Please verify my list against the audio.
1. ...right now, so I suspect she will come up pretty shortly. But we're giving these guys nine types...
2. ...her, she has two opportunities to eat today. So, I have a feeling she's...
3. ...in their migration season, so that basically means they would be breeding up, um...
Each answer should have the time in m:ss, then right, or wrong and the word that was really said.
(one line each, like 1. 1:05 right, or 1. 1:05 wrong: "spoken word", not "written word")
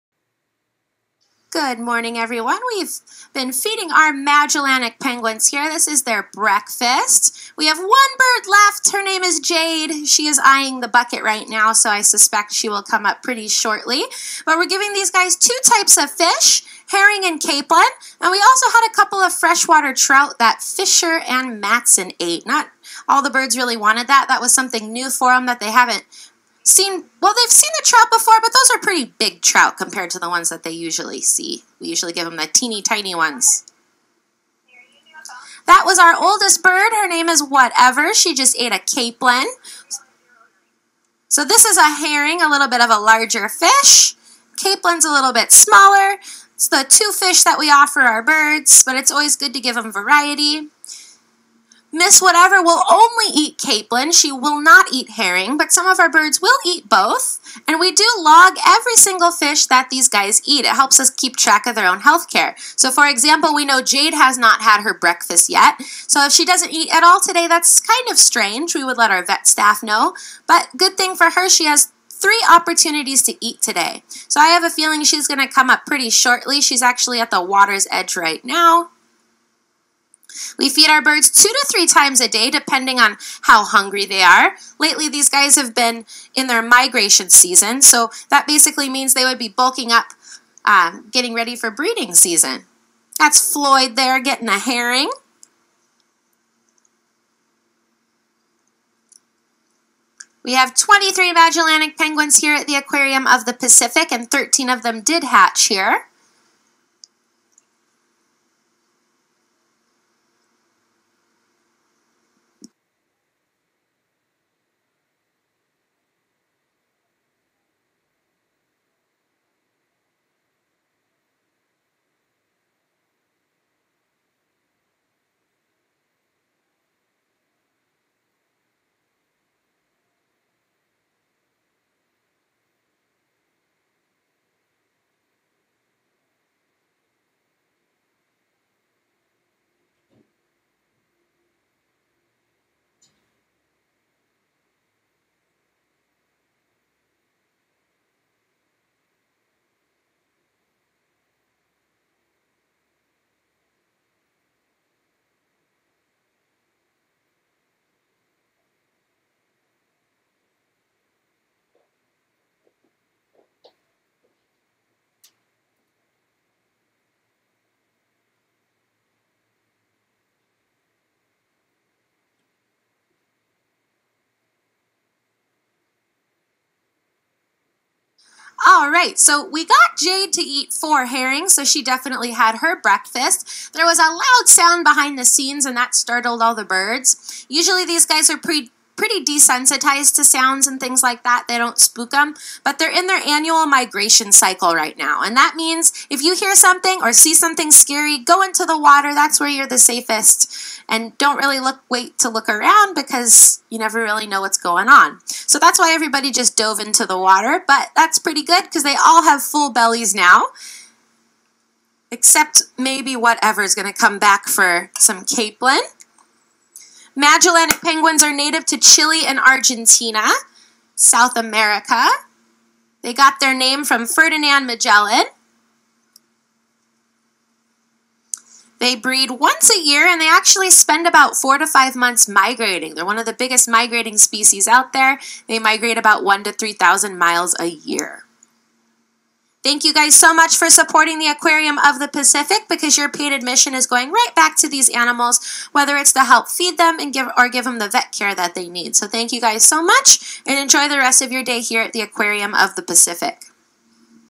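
1. 0:11 wrong: "two", not "nine"
2. 1:11 wrong: "three", not "two"
3. 1:26 wrong: "bulking", not "breeding".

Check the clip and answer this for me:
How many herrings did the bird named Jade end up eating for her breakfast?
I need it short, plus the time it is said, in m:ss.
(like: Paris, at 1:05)
4, at 3:00.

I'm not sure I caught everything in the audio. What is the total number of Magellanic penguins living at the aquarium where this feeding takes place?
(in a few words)
23.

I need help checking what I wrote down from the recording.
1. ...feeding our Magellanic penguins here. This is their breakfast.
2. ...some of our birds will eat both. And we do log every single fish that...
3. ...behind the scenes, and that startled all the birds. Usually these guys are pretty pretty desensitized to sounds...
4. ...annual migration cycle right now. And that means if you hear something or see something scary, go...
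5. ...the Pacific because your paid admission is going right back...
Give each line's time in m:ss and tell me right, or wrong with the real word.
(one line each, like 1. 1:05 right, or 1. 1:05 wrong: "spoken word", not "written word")
1. 0:03 right
2. 0:55 right
3. 3:04 right
4. 3:13 right
5. 4:01 right.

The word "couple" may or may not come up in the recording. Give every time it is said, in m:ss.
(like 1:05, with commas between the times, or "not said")
0:18.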